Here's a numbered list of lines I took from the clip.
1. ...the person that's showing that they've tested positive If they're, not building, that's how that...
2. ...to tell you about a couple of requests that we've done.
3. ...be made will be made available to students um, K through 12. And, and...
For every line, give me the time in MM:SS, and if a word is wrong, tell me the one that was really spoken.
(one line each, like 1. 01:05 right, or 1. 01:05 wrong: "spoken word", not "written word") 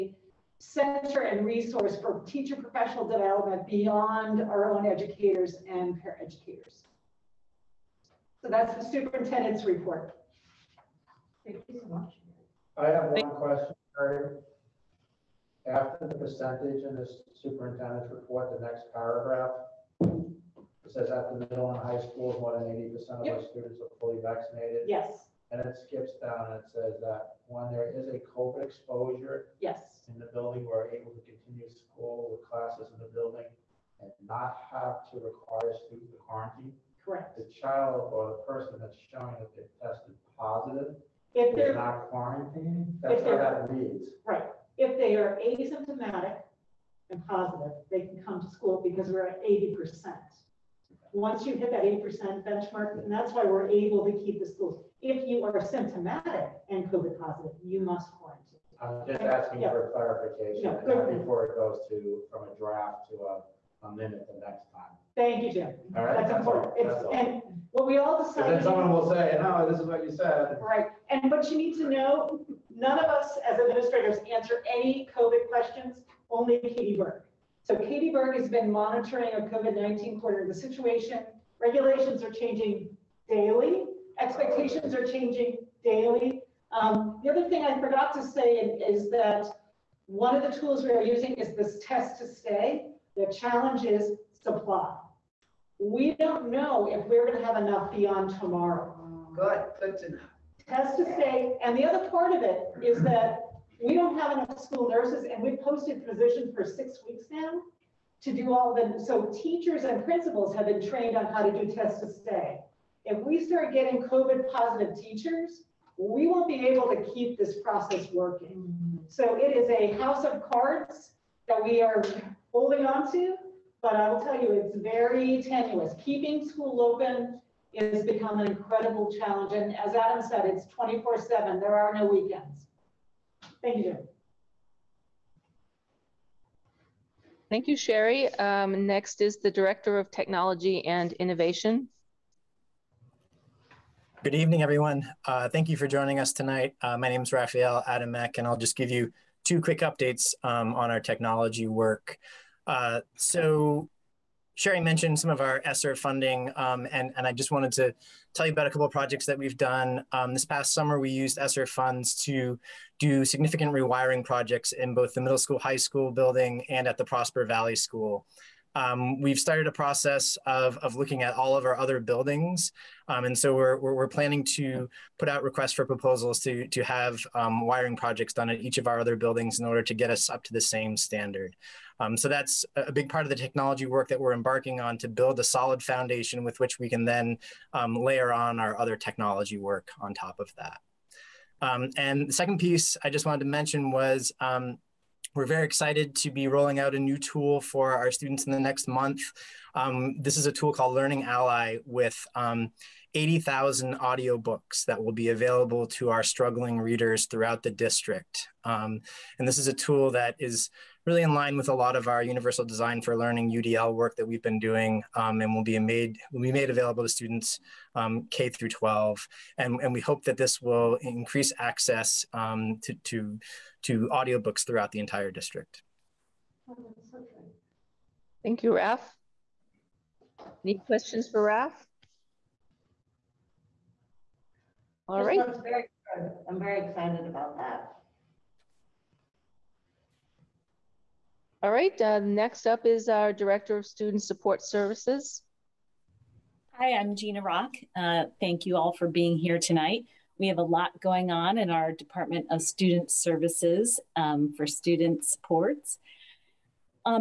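1. 00:38 wrong: "quarantining", not "building"
2. 02:37 wrong: "projects", not "requests"
3. 03:35 right.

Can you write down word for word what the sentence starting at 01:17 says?
So Katie Burke has been monitoring a COVID-19 quarter of the situation.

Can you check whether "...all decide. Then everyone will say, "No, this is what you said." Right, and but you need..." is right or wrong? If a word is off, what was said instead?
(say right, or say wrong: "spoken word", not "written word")
wrong: "someone", not "everyone".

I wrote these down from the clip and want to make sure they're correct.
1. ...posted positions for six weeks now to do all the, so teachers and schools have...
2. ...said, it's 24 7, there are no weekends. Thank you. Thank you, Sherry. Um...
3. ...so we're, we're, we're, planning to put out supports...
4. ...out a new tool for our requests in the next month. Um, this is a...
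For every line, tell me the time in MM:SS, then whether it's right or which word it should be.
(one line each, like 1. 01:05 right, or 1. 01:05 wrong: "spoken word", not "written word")
1. 01:45 wrong: "principals", not "schools"
2. 02:10 right
3. 02:53 wrong: "requests", not "supports"
4. 03:16 wrong: "students", not "requests".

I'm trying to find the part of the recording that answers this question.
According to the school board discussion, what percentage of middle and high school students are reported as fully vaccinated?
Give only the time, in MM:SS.
00:22.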